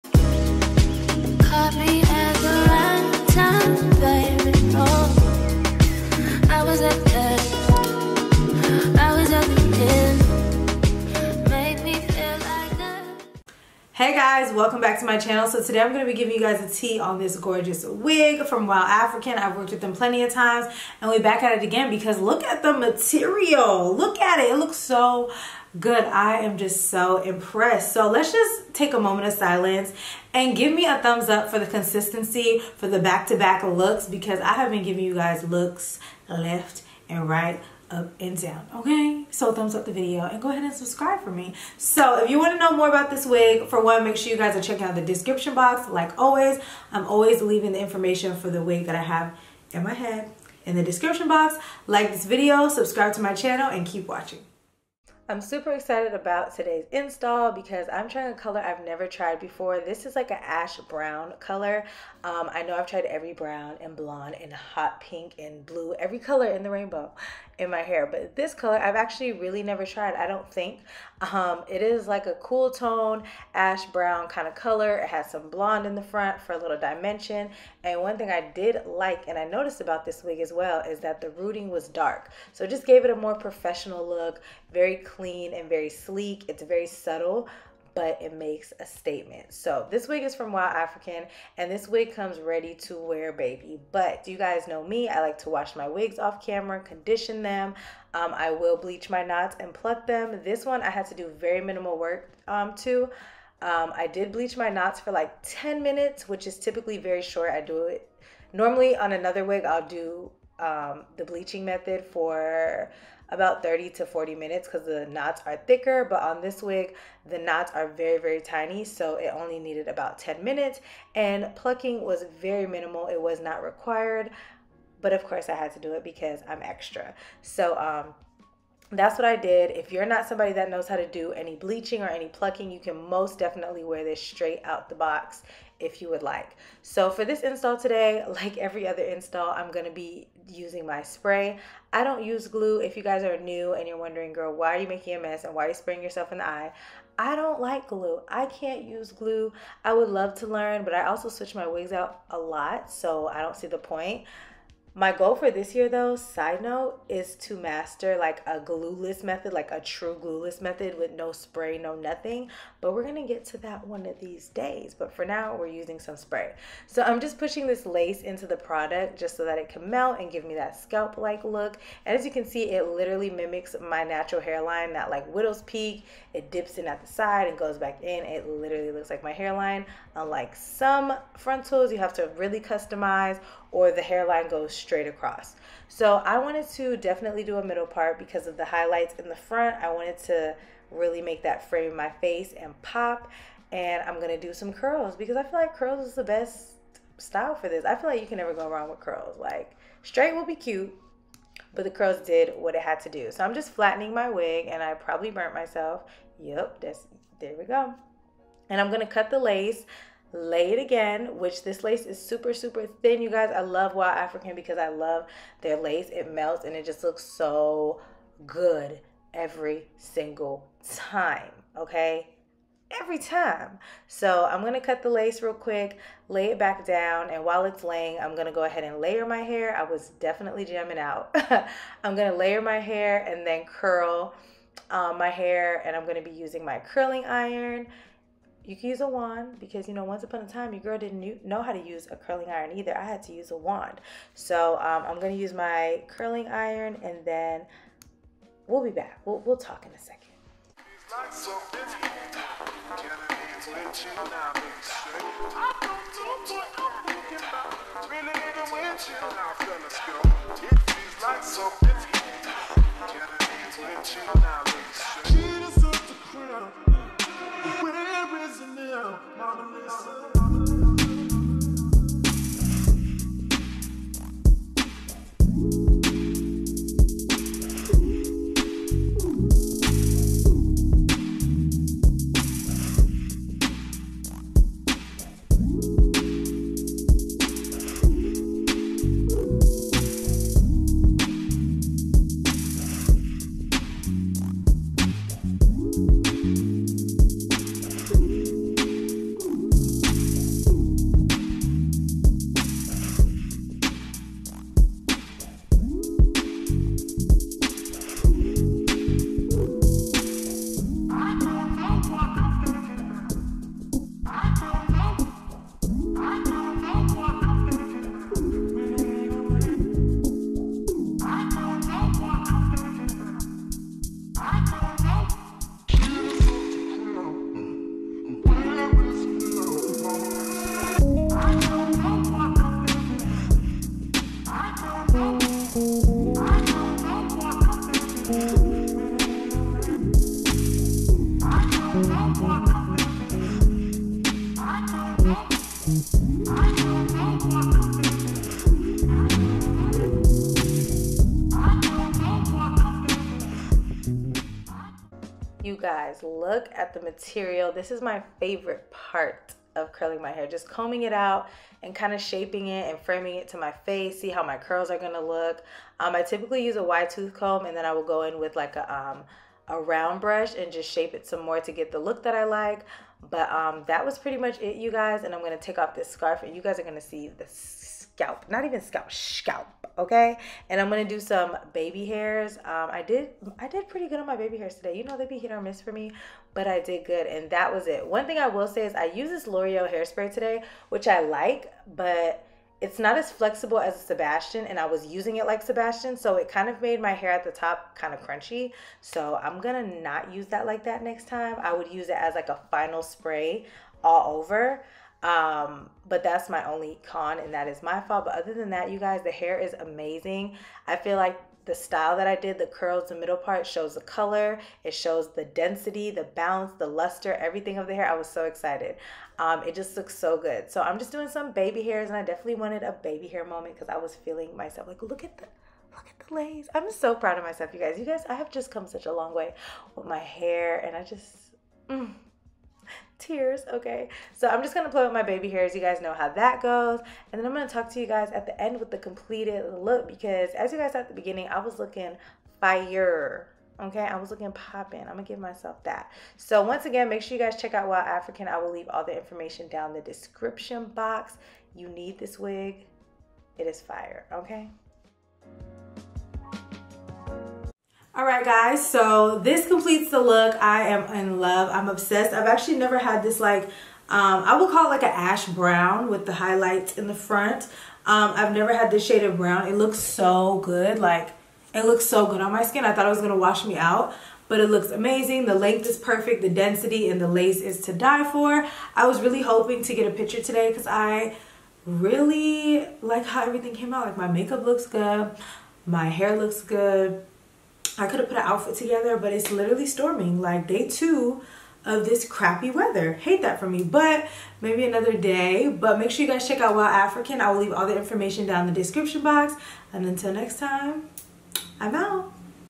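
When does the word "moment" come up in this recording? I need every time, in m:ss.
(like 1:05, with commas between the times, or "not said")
0:28, 7:03.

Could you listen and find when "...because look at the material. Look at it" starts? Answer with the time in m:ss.
0:21.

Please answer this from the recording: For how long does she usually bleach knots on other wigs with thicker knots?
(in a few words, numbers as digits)
30 to 40 minutes.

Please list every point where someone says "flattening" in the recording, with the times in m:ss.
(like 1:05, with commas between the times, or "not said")
3:23.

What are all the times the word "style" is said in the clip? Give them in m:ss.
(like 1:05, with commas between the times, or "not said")
3:17, 6:51.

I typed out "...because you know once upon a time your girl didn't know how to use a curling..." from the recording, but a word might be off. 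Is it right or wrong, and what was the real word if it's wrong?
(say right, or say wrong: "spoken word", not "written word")
right.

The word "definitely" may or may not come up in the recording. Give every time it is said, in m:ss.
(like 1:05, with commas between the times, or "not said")
2:13, 3:06, 3:50, 7:02.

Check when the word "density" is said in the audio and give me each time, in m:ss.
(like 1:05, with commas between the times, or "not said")
6:55, 7:56.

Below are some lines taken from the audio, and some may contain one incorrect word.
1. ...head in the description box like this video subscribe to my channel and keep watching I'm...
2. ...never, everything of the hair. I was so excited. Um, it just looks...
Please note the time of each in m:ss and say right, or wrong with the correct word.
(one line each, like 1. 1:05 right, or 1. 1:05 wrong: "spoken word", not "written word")
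1. 0:49 right
2. 6:56 wrong: "luster", not "never".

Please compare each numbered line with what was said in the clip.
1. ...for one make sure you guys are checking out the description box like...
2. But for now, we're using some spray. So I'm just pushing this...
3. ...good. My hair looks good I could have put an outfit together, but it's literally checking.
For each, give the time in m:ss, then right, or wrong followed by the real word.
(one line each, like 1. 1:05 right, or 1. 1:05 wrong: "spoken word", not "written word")
1. 0:43 right
2. 2:44 right
3. 8:04 wrong: "storming", not "checking".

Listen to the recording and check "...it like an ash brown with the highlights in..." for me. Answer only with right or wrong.
right.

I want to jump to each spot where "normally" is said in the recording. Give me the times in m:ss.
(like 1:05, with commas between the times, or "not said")
1:48.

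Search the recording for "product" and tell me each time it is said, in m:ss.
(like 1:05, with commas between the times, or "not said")
2:48.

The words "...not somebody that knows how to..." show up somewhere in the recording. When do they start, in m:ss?
2:10.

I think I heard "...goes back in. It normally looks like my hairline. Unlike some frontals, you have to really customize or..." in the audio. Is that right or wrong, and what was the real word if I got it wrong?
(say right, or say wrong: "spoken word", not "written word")
wrong: "literally", not "normally".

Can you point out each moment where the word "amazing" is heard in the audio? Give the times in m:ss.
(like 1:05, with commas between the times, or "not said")
6:49, 7:54.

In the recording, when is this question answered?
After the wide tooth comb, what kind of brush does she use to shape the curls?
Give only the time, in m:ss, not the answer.
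6:09.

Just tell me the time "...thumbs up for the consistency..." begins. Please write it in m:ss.
0:30.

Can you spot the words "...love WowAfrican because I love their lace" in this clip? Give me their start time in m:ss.
3:33.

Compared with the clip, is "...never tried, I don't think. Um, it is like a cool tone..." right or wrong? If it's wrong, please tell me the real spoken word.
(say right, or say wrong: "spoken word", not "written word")
right.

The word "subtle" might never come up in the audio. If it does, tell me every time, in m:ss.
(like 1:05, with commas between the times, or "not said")
1:26.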